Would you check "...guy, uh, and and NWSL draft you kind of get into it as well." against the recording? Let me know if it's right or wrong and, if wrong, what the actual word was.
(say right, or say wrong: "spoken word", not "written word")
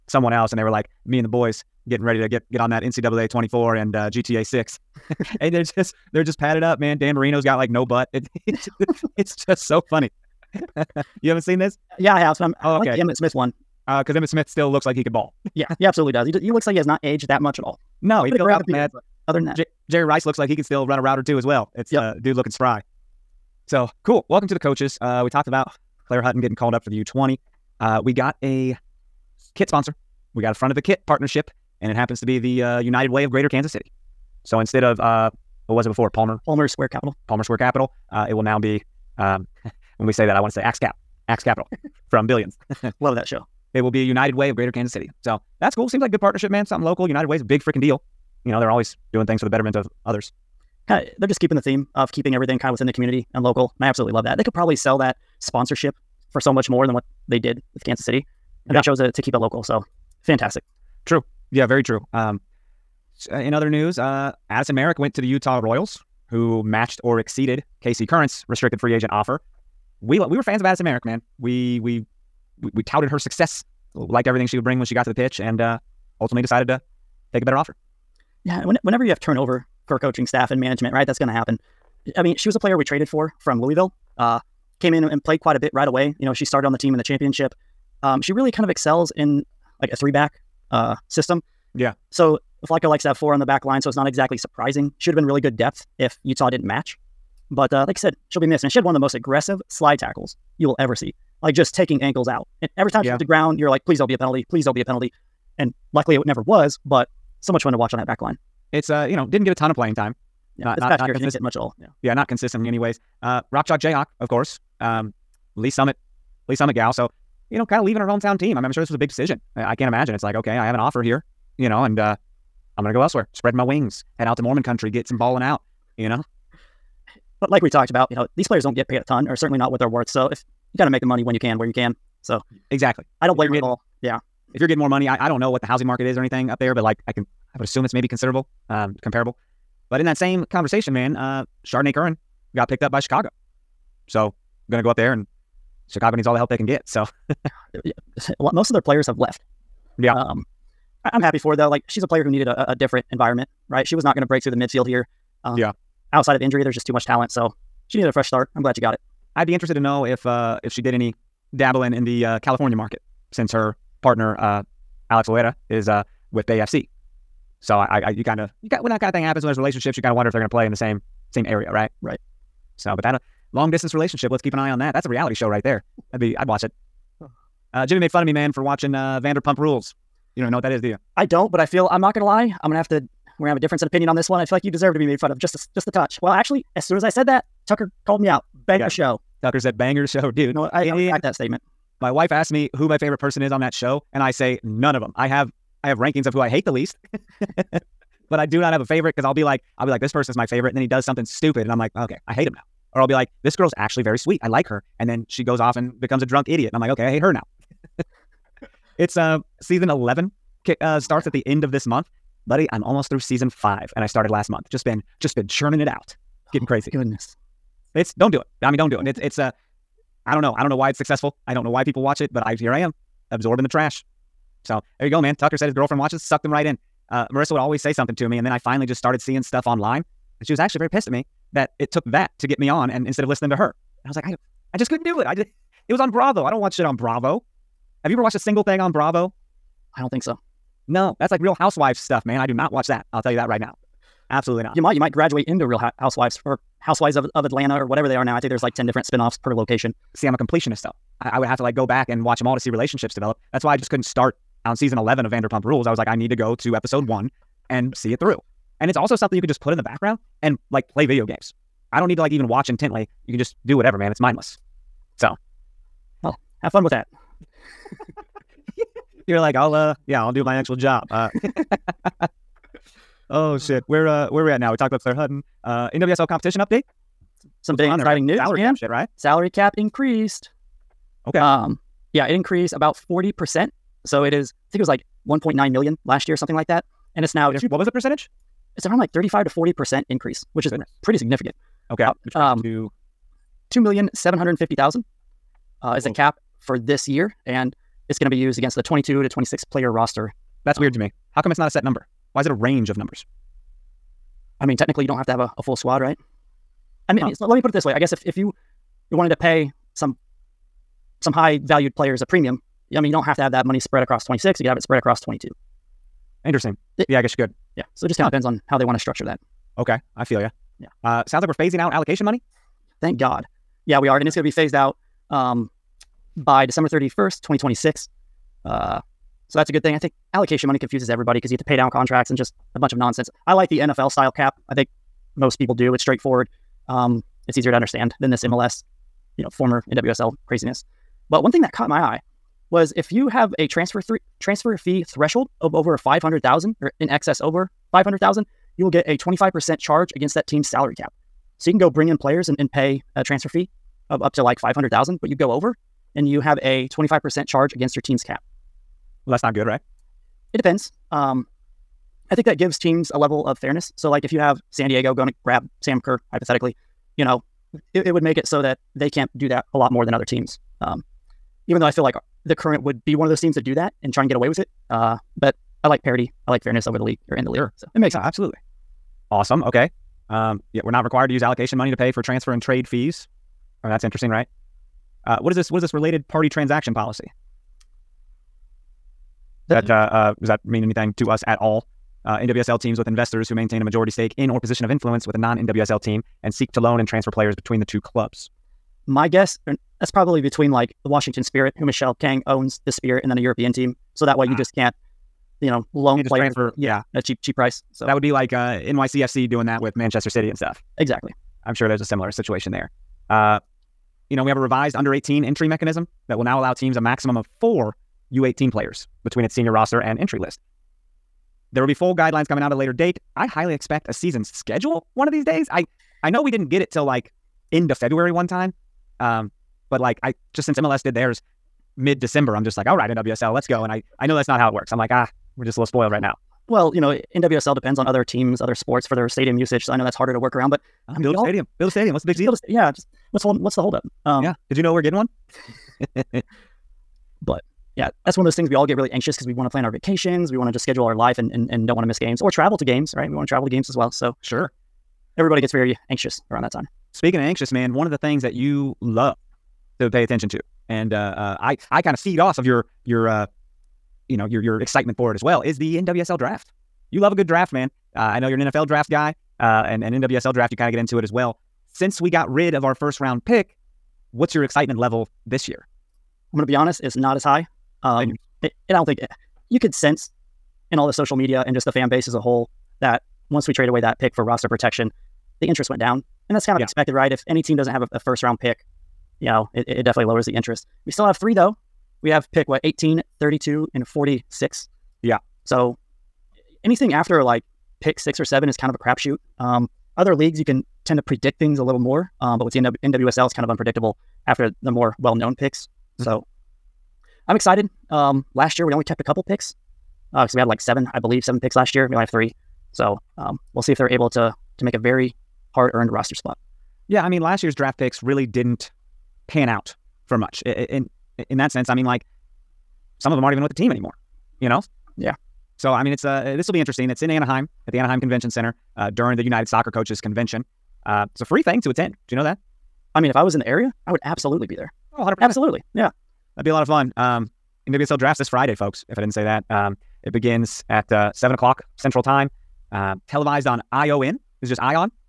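right.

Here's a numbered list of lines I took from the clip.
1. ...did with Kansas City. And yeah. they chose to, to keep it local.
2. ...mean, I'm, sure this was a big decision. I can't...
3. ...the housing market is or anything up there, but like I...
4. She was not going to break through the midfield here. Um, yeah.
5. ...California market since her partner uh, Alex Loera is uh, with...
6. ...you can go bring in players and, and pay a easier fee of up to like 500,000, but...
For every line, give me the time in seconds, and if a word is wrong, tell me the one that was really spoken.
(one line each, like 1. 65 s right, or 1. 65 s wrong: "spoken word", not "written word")
1. 57 s right
2. 118 s right
3. 135 s right
4. 153 s right
5. 162 s right
6. 351 s wrong: "transfer", not "easier".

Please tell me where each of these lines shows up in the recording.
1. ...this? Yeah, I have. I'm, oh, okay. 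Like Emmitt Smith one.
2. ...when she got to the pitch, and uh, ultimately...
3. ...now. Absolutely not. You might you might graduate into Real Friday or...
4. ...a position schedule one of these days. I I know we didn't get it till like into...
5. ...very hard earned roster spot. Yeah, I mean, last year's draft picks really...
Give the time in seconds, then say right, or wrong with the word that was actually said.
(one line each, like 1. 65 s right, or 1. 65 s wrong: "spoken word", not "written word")
1. 11 s right
2. 74 s right
3. 243 s wrong: "Housewives", not "Friday"
4. 424 s wrong: "season", not "position"
5. 514 s right.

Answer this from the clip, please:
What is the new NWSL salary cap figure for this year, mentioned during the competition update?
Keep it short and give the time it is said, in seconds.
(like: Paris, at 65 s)
$2,750,000, at 293 s.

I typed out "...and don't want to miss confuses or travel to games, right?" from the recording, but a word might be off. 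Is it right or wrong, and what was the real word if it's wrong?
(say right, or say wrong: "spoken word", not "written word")
wrong: "games", not "confuses".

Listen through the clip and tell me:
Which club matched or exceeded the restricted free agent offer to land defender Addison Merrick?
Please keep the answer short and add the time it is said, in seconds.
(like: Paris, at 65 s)
Utah Royals, at 65 s.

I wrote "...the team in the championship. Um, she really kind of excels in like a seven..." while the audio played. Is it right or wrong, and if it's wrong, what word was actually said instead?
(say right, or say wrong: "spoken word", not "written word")
wrong: "three", not "seven".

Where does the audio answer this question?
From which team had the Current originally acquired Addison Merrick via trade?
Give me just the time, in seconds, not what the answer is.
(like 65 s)
83 s.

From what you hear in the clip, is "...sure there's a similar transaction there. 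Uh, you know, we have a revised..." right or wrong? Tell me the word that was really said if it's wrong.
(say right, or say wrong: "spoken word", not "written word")
wrong: "situation", not "transaction".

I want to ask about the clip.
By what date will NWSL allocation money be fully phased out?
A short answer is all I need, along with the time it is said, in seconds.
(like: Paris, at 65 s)
December 31st, 2026, at 326 s.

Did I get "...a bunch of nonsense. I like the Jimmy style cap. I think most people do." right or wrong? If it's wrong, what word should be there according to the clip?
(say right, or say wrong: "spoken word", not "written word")
wrong: "NFL", not "Jimmy".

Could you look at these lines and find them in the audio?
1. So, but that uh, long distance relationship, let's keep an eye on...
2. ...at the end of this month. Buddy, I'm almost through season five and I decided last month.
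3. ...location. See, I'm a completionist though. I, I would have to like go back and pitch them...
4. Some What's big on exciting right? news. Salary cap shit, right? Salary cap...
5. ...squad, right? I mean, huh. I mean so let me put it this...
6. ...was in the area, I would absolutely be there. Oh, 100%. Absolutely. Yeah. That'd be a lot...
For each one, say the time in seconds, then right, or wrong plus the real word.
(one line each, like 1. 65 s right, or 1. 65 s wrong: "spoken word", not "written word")
1. 172 s right
2. 211 s wrong: "started", not "decided"
3. 249 s wrong: "watch", not "pitch"
4. 277 s right
5. 305 s right
6. 533 s right.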